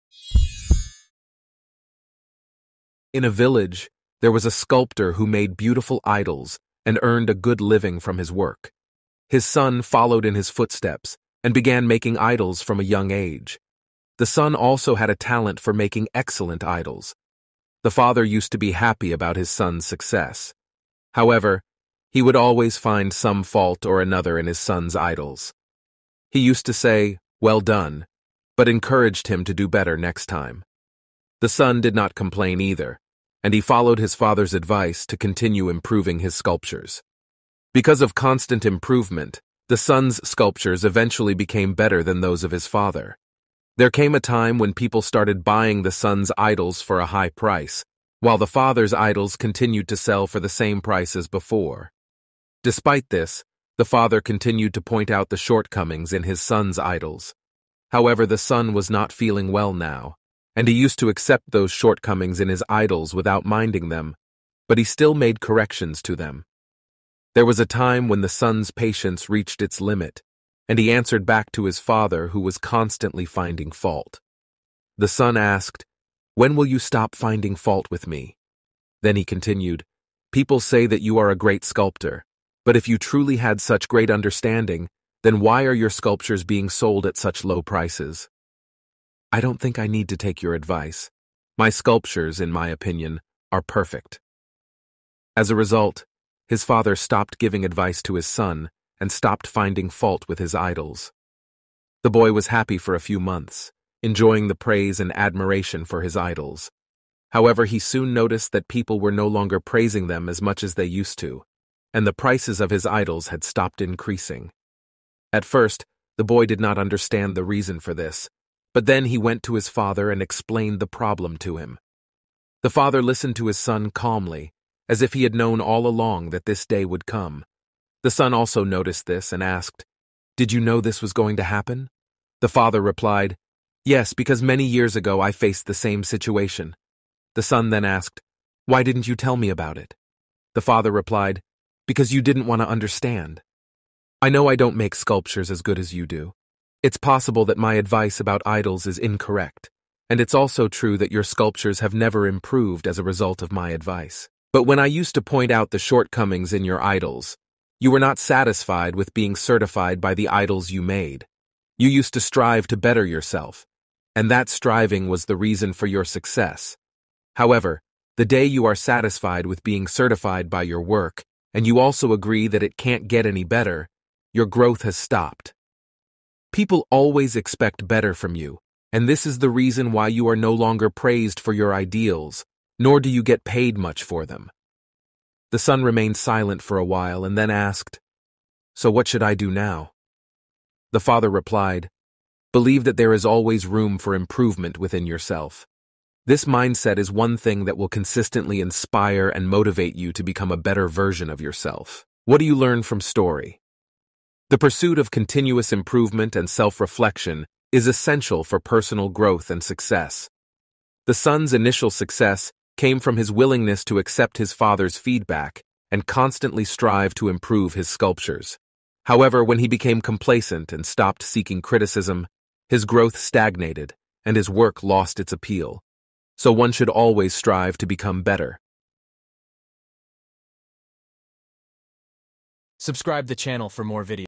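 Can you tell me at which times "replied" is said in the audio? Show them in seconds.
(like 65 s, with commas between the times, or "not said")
132 s, 140 s, 191 s.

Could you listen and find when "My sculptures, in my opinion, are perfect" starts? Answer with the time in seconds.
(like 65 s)
91 s.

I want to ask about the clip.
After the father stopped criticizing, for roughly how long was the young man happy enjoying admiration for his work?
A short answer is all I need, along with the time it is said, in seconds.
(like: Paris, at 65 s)
a few months, at 102 s.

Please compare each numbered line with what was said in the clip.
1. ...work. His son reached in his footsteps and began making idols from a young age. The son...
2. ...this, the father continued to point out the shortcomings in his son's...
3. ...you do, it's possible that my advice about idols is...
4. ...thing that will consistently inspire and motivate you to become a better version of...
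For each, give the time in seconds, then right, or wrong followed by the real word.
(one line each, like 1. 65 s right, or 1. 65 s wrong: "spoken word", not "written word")
1. 8 s wrong: "followed", not "reached"
2. 53 s right
3. 145 s right
4. 197 s right.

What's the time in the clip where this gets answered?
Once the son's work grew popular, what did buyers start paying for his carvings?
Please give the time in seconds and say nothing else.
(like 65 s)
46 s.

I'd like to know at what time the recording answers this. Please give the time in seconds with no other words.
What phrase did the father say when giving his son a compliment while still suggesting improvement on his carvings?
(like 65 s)
27 s.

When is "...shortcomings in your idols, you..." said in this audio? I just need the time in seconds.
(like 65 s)
155 s.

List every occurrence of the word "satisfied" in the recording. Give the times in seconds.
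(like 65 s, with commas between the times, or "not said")
158 s, 168 s.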